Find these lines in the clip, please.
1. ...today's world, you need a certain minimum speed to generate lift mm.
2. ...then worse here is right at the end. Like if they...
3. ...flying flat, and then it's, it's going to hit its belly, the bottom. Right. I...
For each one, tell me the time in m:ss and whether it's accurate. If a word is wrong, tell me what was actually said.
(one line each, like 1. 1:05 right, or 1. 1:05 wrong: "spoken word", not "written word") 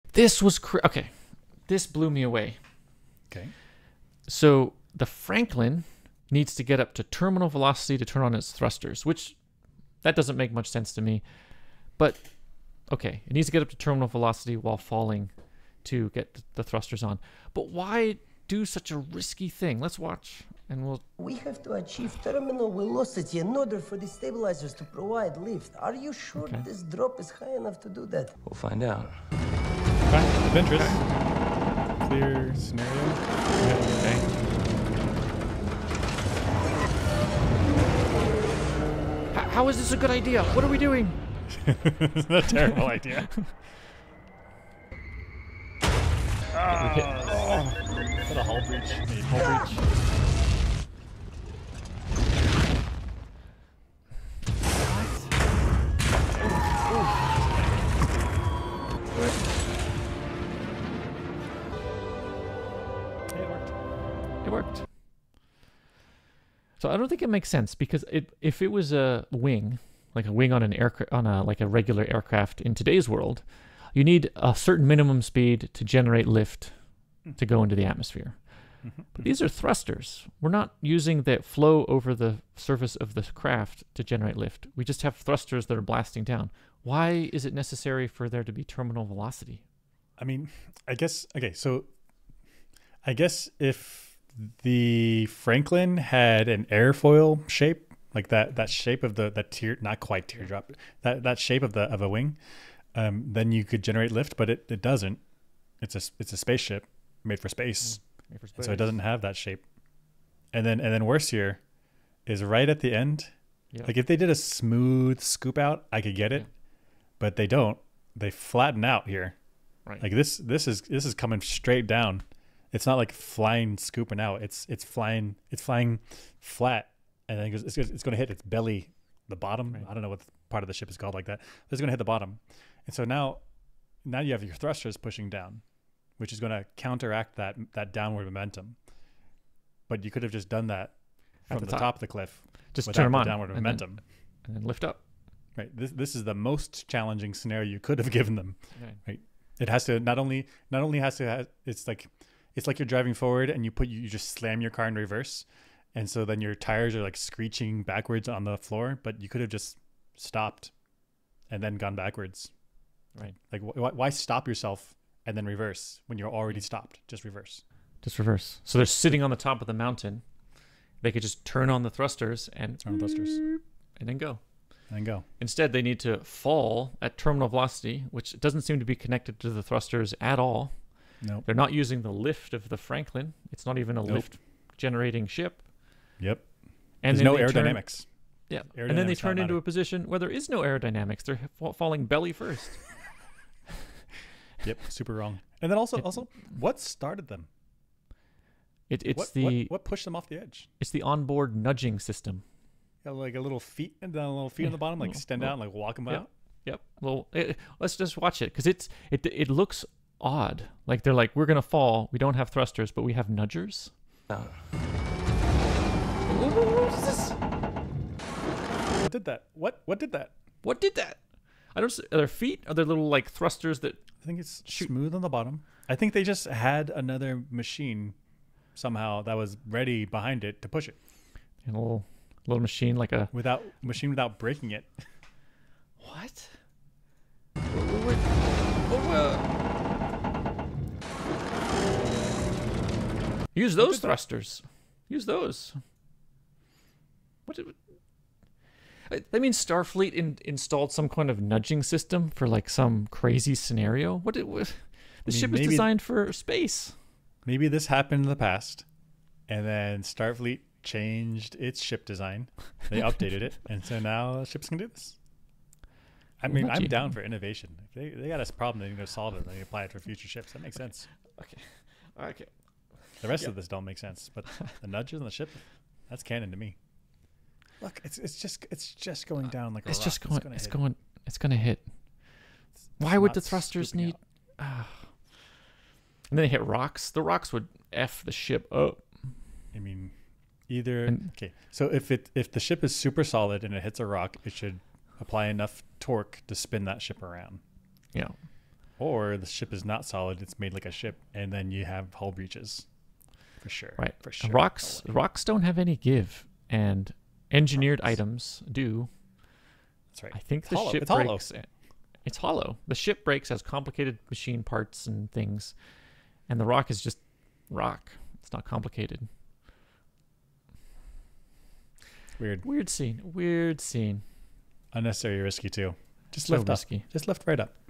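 1. 1:12 right
2. 1:50 right
3. 2:05 right.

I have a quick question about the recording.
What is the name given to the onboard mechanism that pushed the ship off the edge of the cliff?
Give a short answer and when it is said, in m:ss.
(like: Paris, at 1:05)
Onboard nudging system, at 3:21.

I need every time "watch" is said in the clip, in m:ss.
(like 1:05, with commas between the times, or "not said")
0:19, 3:28.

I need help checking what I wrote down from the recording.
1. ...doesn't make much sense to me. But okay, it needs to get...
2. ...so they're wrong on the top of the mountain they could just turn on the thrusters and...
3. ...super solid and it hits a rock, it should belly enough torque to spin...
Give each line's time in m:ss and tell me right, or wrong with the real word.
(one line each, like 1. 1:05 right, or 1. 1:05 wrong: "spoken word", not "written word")
1. 0:10 right
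2. 2:48 wrong: "sitting", not "wrong"
3. 4:52 wrong: "apply", not "belly".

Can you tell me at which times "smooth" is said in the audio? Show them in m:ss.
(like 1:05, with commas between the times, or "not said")
1:54, 3:44.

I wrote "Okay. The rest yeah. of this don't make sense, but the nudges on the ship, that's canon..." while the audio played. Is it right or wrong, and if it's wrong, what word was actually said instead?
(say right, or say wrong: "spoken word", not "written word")
right.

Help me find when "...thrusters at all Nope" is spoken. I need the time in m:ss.
2:59.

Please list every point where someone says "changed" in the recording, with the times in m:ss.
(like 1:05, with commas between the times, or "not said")
4:20.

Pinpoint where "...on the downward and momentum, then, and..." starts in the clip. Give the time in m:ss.
2:23.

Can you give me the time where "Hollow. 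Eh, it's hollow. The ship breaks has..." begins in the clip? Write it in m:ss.
5:11.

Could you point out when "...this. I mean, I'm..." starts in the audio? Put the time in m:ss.
4:24.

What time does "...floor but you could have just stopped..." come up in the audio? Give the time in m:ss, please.
2:38.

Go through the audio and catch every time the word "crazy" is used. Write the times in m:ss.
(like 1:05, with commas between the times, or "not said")
4:13.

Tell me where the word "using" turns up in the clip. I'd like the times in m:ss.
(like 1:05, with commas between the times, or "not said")
1:20, 3:01.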